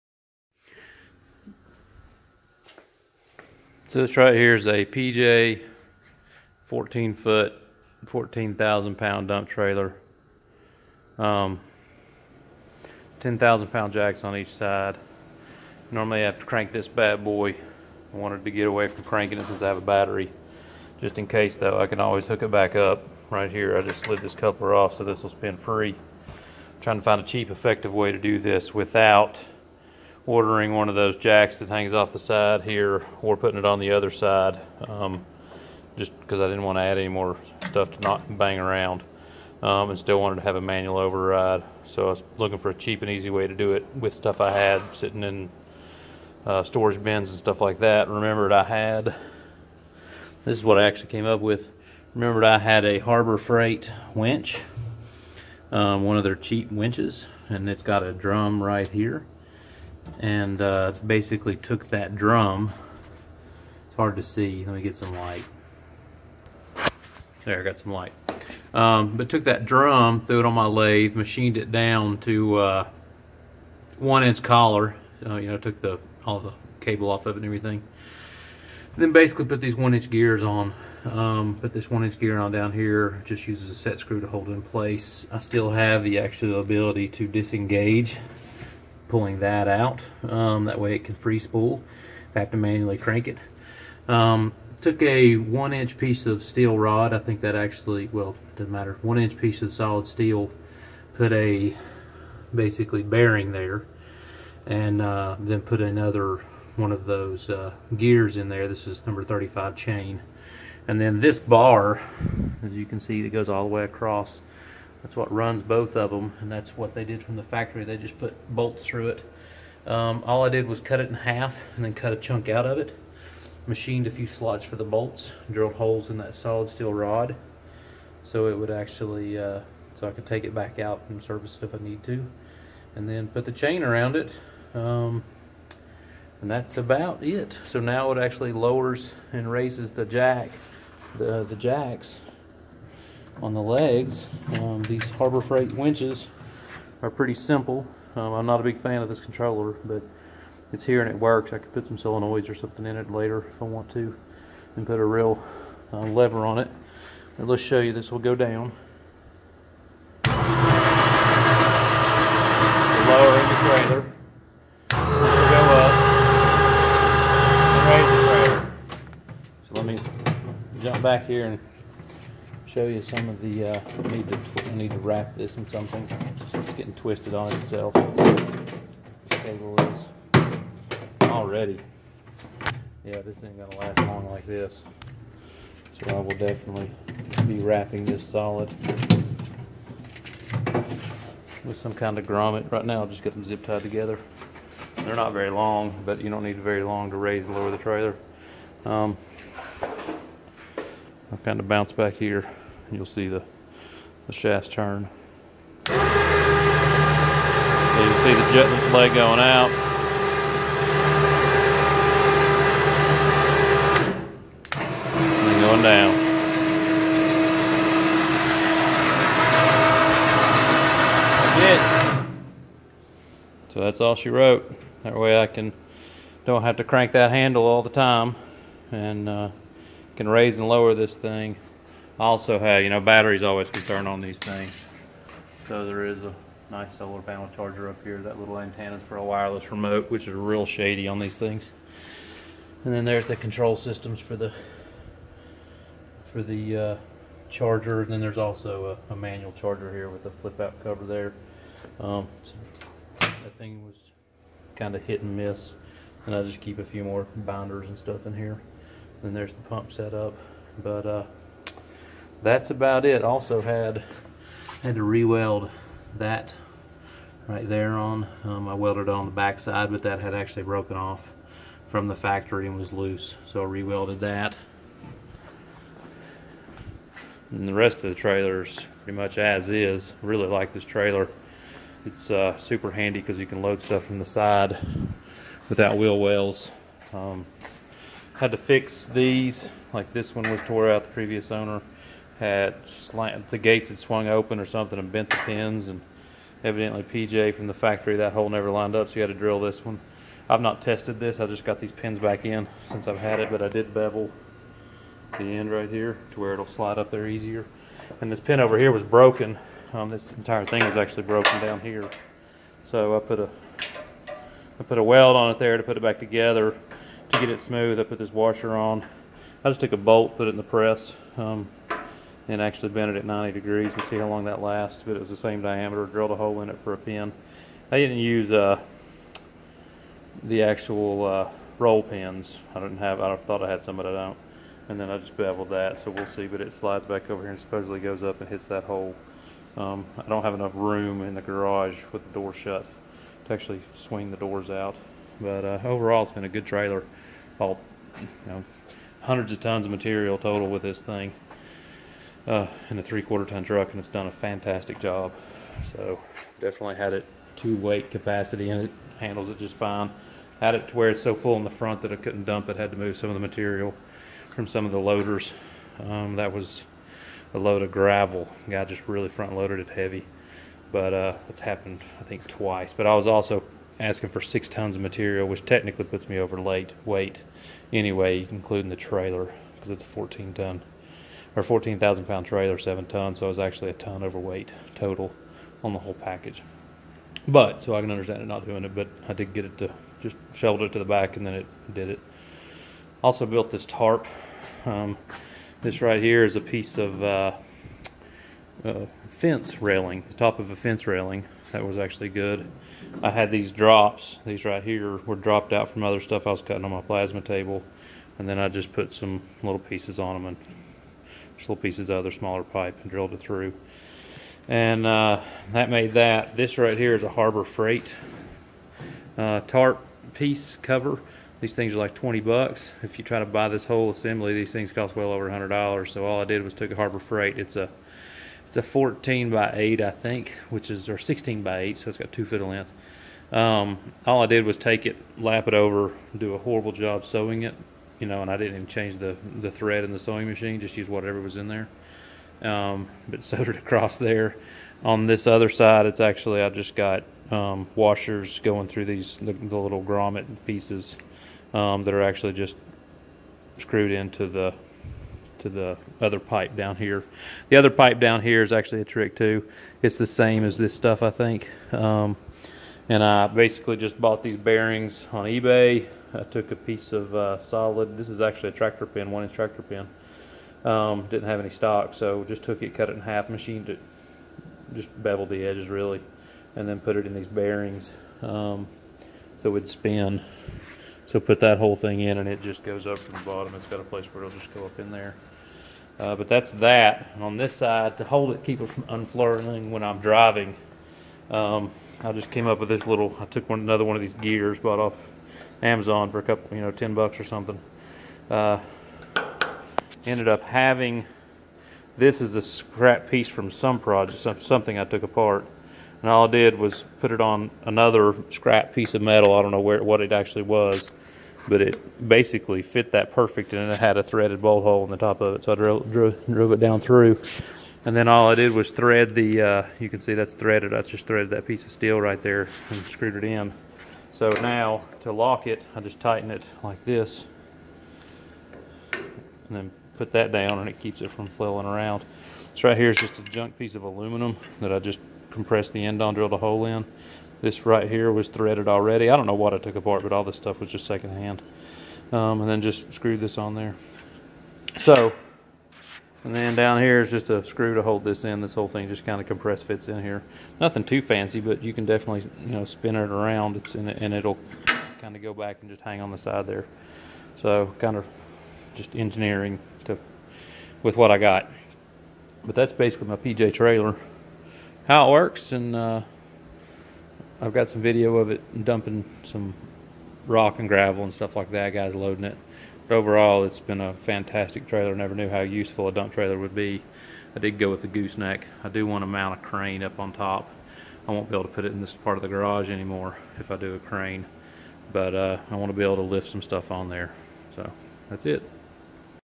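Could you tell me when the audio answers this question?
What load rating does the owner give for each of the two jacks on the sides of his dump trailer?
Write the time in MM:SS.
00:13.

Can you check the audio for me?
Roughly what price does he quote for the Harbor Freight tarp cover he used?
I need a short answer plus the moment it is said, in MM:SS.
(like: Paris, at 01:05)
20 bucks, at 07:02.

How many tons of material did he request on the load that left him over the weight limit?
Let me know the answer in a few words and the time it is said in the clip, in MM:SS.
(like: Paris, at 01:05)
6 tons, at 06:14.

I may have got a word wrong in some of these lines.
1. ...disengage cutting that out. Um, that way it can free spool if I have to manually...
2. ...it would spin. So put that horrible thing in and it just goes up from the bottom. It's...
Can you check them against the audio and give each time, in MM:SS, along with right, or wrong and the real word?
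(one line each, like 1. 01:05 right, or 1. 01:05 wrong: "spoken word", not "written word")
1. 01:27 wrong: "pulling", not "cutting"
2. 07:59 wrong: "whole", not "horrible".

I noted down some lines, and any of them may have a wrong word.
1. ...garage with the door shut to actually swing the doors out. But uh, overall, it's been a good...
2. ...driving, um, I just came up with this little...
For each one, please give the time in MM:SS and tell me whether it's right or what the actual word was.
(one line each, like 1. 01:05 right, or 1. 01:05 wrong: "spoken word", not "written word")
1. 05:41 right
2. 08:10 right.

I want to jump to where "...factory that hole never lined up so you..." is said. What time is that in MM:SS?
04:57.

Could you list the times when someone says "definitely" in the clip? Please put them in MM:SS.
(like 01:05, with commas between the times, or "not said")
03:06, 05:56, 09:12.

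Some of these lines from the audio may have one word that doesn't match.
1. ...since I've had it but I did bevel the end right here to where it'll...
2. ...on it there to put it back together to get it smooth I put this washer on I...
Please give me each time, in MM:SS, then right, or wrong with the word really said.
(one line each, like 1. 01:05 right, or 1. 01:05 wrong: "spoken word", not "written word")
1. 05:02 right
2. 05:15 right.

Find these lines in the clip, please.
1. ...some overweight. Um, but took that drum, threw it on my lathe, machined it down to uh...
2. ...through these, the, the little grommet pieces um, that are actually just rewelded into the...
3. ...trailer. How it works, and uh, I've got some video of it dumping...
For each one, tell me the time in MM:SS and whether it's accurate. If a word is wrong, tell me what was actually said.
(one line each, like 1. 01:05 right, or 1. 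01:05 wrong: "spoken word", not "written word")
1. 01:07 wrong: "light", not "overweight"
2. 07:28 wrong: "screwed", not "rewelded"
3. 09:23 right.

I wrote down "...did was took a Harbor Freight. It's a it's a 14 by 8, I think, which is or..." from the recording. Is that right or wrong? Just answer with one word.
right.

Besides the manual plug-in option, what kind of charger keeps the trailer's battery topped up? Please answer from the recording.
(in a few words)
Solar panel charger.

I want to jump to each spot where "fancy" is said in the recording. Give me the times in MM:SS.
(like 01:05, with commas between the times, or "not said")
09:11.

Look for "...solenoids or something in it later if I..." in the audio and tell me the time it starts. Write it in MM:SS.
02:31.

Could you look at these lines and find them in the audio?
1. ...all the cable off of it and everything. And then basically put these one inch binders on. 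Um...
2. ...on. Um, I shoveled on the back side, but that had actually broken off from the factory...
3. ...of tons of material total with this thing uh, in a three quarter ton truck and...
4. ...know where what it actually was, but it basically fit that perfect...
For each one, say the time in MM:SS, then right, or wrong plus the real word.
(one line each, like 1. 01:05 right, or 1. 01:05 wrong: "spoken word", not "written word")
1. 01:16 wrong: "gears", not "binders"
2. 04:27 wrong: "welded", not "shoveled"
3. 05:49 right
4. 08:29 right.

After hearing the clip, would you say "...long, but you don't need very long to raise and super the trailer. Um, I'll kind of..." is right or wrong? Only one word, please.
wrong.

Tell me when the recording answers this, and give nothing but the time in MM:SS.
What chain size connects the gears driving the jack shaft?
01:49.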